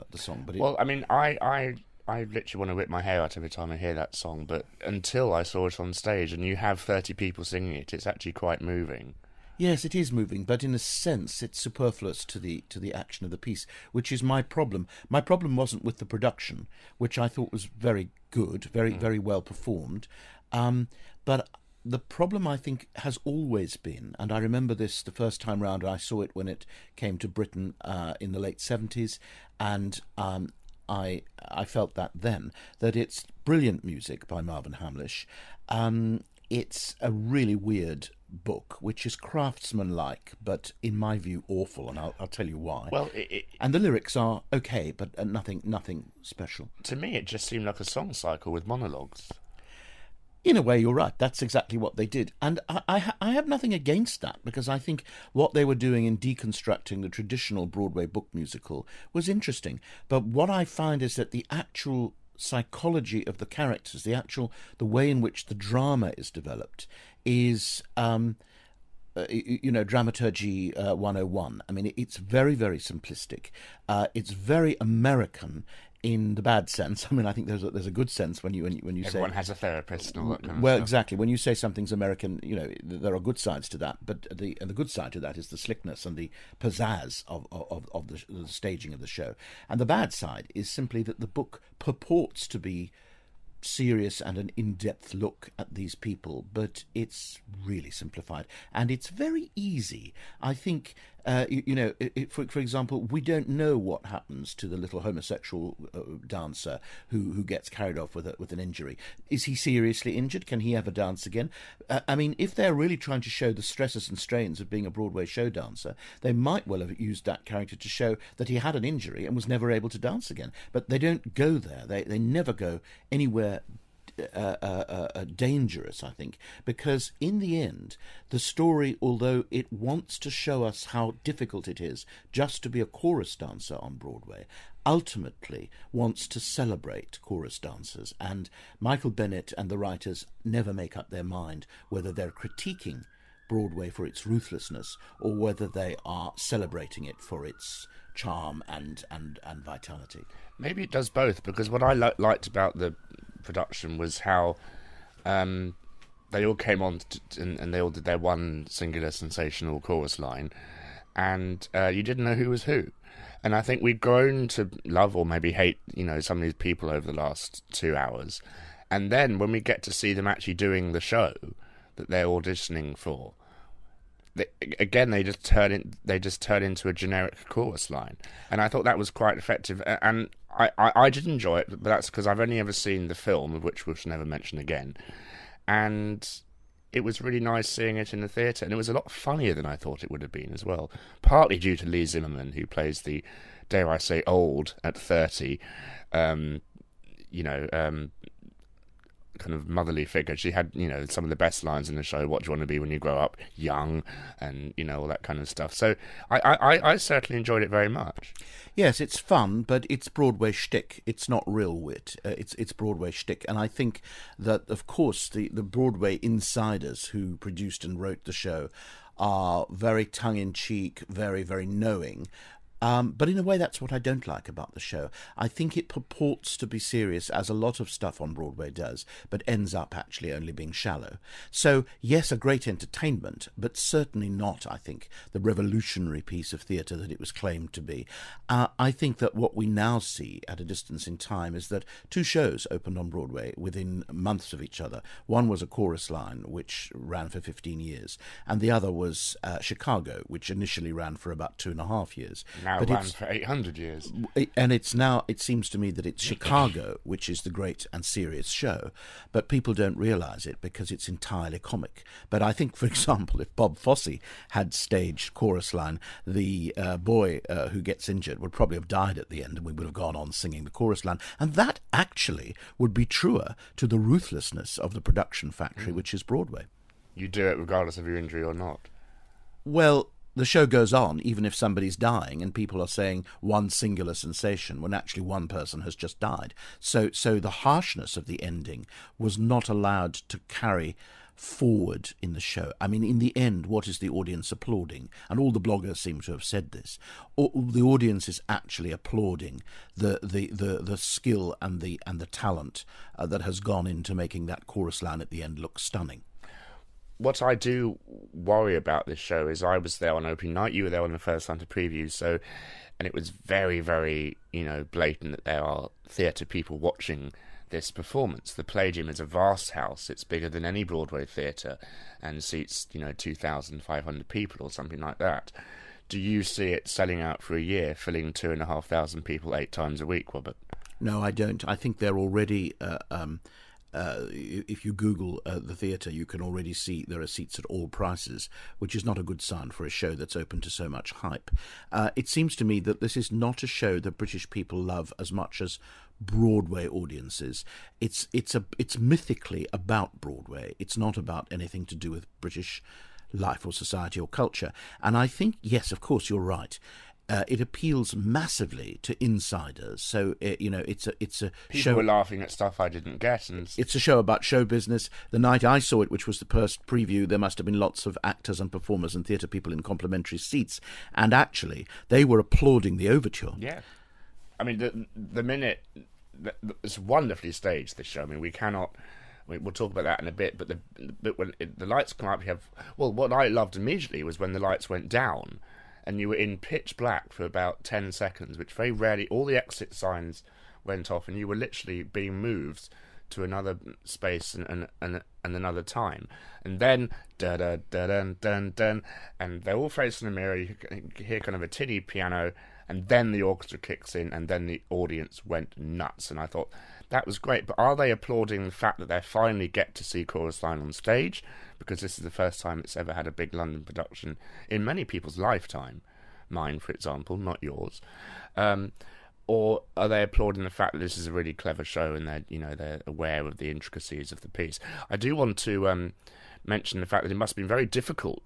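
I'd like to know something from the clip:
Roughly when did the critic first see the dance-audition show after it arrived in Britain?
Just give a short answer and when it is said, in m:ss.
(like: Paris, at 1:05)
late seventies, at 0:28.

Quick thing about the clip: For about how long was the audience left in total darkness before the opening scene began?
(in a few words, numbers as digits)
10 seconds.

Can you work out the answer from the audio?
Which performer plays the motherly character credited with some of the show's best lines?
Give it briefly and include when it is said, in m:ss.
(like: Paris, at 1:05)
Leigh Zimmerman, at 3:11.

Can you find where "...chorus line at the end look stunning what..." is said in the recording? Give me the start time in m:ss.
5:04.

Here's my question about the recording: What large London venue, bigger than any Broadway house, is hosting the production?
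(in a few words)
The Palladium.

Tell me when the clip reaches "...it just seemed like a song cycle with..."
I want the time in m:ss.
0:47.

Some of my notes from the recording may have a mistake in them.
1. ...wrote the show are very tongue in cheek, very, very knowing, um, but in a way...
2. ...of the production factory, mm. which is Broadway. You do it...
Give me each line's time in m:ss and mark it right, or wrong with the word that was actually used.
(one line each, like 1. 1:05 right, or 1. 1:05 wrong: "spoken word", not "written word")
1. 3:37 right
2. 4:34 right.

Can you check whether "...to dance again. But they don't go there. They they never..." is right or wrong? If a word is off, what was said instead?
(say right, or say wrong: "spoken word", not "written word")
right.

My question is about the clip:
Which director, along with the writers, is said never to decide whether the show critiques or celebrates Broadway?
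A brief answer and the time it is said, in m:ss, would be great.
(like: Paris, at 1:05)
Michael Bennett, at 2:18.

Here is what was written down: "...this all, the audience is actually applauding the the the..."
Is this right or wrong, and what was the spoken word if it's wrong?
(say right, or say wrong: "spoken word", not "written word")
right.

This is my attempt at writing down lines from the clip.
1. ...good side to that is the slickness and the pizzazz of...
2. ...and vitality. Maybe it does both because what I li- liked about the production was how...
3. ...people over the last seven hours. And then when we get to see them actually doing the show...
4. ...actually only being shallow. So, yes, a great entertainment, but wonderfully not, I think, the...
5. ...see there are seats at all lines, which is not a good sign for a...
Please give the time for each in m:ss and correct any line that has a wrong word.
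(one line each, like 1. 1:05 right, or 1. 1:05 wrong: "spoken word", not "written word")
1. 1:24 right
2. 2:29 right
3. 2:46 wrong: "two", not "seven"
4. 3:49 wrong: "certainly", not "wonderfully"
5. 5:36 wrong: "prices", not "lines".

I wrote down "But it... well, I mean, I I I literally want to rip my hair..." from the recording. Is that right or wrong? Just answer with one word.
right.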